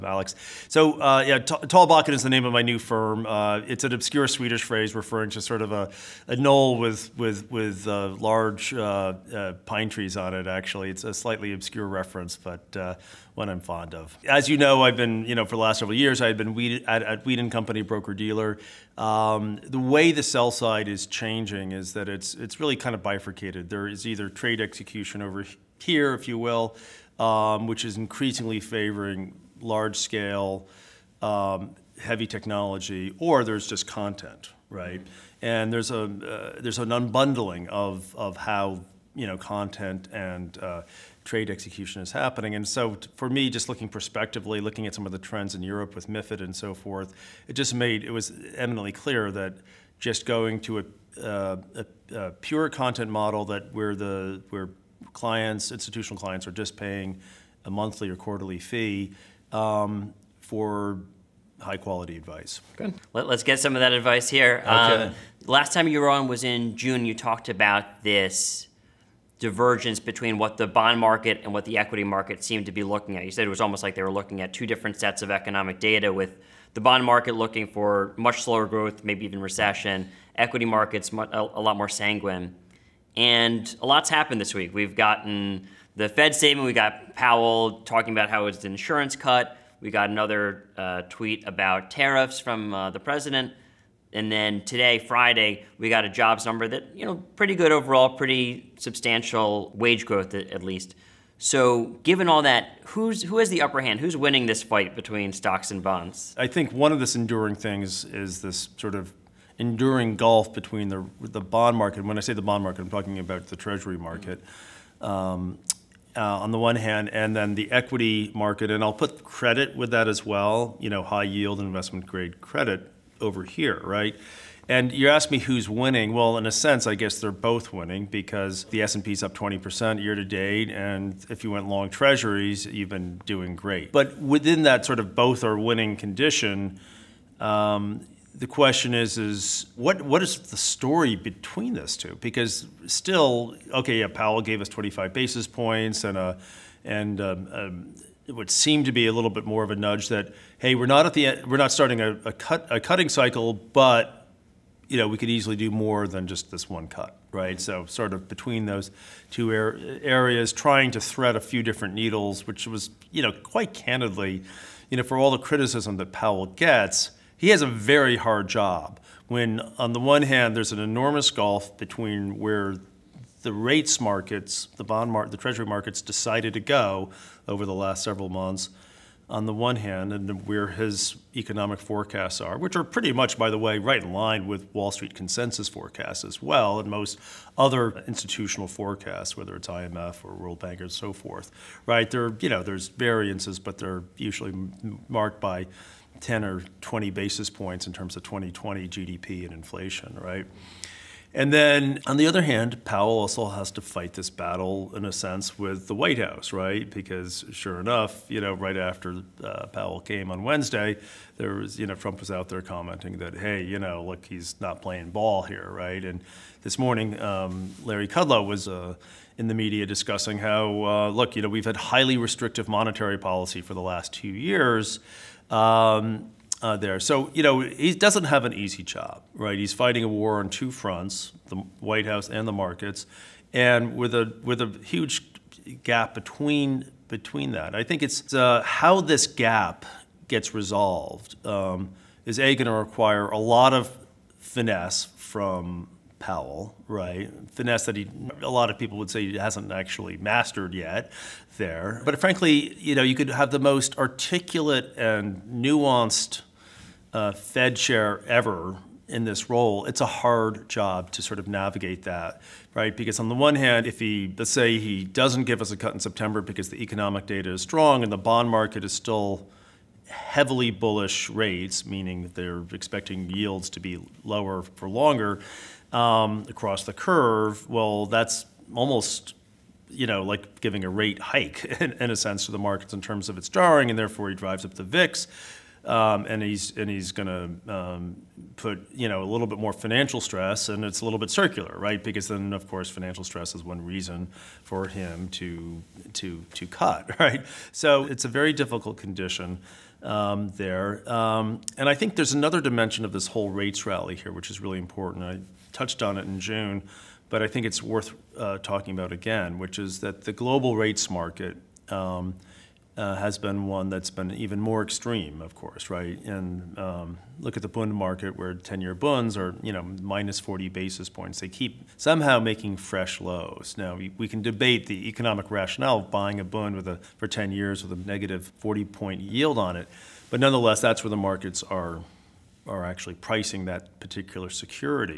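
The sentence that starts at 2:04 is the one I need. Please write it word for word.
And you ask me who's winning.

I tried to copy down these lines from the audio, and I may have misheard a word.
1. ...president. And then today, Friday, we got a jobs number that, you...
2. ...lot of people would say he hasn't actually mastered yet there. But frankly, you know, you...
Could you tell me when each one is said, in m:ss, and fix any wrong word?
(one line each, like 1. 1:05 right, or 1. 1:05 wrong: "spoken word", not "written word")
1. 1:32 right
2. 4:08 right.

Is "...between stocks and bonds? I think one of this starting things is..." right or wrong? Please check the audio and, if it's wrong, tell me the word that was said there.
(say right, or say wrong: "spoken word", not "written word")
wrong: "enduring", not "starting".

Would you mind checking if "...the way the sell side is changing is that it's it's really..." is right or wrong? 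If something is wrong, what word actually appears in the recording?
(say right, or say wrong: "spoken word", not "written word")
right.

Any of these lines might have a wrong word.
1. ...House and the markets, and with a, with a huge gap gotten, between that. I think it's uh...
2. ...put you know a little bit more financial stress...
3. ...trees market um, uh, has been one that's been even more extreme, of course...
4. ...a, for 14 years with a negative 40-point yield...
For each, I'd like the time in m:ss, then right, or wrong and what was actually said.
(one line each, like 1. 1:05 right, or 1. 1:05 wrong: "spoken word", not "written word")
1. 3:52 wrong: "between", not "gotten"
2. 4:48 right
3. 5:10 wrong: "rates", not "trees"
4. 5:26 wrong: "10", not "14".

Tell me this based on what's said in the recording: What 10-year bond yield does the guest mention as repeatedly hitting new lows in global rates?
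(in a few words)
minus 40 basis points.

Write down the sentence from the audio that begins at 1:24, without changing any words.
We've gotten the Fed statement, we got Powell talking about how it's an insurance cut.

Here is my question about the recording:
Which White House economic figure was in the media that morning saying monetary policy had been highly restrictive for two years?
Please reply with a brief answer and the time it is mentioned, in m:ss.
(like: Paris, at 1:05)
Larry Kudlow, at 3:37.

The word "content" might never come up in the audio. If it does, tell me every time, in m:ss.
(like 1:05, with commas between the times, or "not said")
0:33, 0:39, 0:52.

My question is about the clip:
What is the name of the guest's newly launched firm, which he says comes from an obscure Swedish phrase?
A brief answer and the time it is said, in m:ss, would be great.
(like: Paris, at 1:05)
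Tallbacken, at 0:01.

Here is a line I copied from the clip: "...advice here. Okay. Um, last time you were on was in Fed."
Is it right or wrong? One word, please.
wrong.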